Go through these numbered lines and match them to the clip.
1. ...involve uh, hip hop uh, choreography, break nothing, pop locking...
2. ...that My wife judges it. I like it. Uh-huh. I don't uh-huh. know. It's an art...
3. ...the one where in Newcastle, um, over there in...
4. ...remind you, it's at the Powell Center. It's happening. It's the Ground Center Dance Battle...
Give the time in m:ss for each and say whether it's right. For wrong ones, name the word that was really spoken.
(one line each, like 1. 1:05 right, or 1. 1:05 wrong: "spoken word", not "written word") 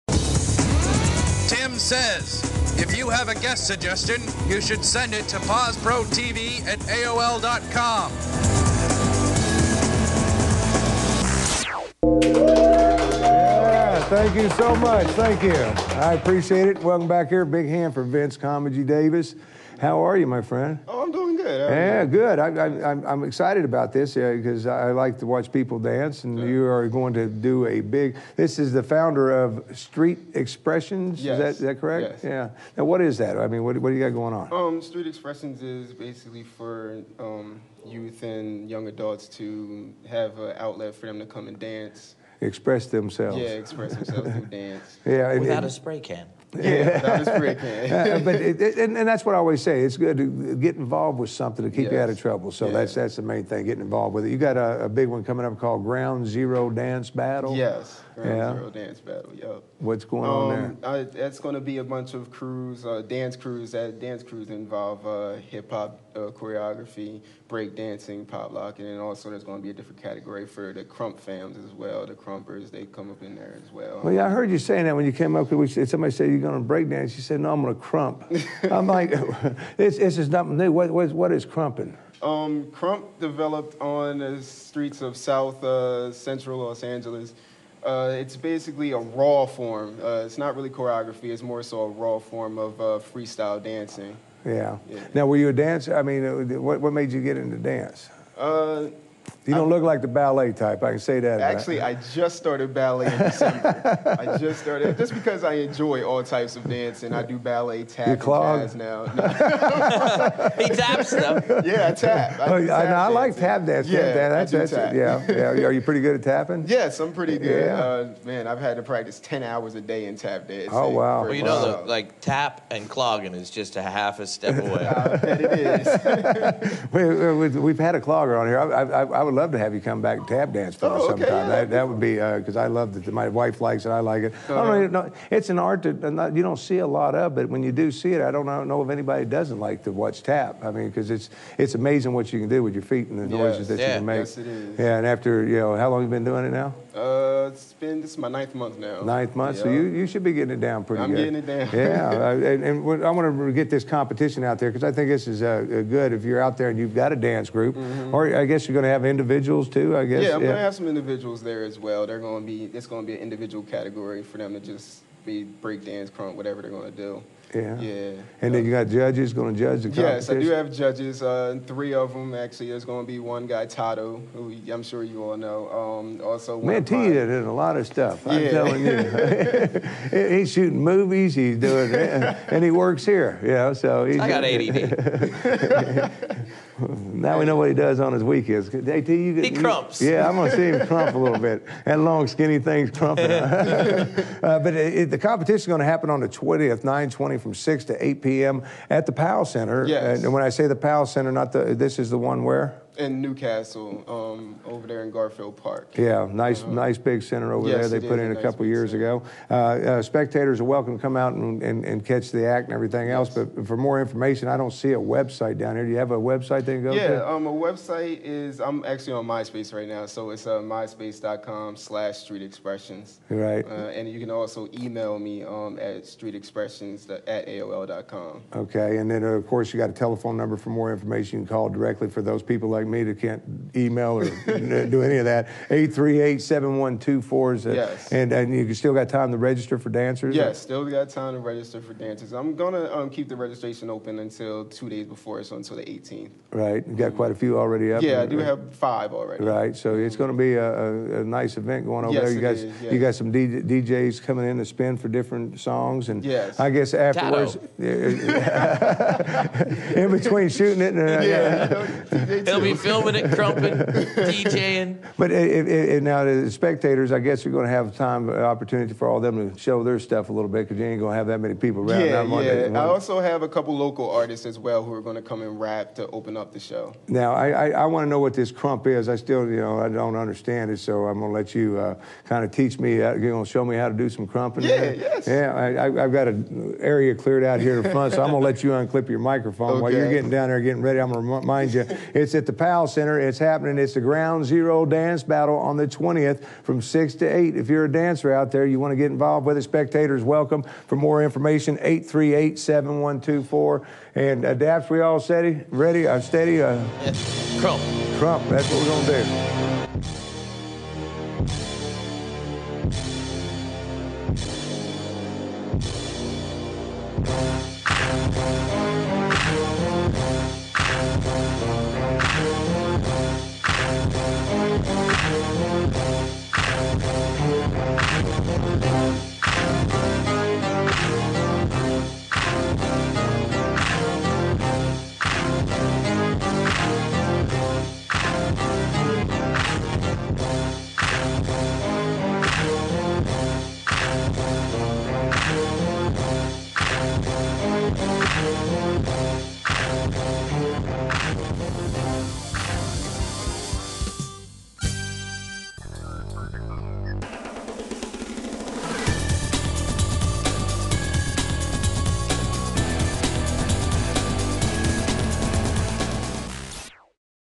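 1. 1:04 wrong: "dancing", not "nothing"
2. 2:12 wrong: "likes", not "judges"
3. 3:22 right
4. 4:51 wrong: "Zero", not "Center".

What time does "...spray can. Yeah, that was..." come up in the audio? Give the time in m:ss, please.
0:45.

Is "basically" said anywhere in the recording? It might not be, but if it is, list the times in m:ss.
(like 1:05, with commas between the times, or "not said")
0:35, 1:28.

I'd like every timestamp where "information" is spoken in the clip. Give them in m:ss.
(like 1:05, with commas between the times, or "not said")
3:34, 3:50, 5:01.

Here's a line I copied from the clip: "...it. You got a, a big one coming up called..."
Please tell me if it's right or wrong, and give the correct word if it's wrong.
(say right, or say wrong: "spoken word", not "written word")
right.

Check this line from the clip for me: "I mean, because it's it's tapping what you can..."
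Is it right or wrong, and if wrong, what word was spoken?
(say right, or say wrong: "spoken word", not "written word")
wrong: "amazing", not "tapping".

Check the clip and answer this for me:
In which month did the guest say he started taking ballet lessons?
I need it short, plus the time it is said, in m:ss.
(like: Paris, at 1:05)
December, at 1:43.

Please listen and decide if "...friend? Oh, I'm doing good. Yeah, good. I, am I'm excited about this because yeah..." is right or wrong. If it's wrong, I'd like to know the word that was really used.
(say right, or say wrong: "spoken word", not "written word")
right.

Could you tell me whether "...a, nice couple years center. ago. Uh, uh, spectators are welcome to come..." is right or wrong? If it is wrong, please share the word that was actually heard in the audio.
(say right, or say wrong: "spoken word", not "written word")
right.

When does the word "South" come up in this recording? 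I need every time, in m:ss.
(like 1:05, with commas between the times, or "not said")
1:25.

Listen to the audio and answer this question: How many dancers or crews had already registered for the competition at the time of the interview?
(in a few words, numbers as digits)
5.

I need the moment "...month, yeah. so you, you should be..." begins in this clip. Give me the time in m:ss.
2:29.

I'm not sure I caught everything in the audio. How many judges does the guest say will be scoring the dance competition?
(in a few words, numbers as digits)
3.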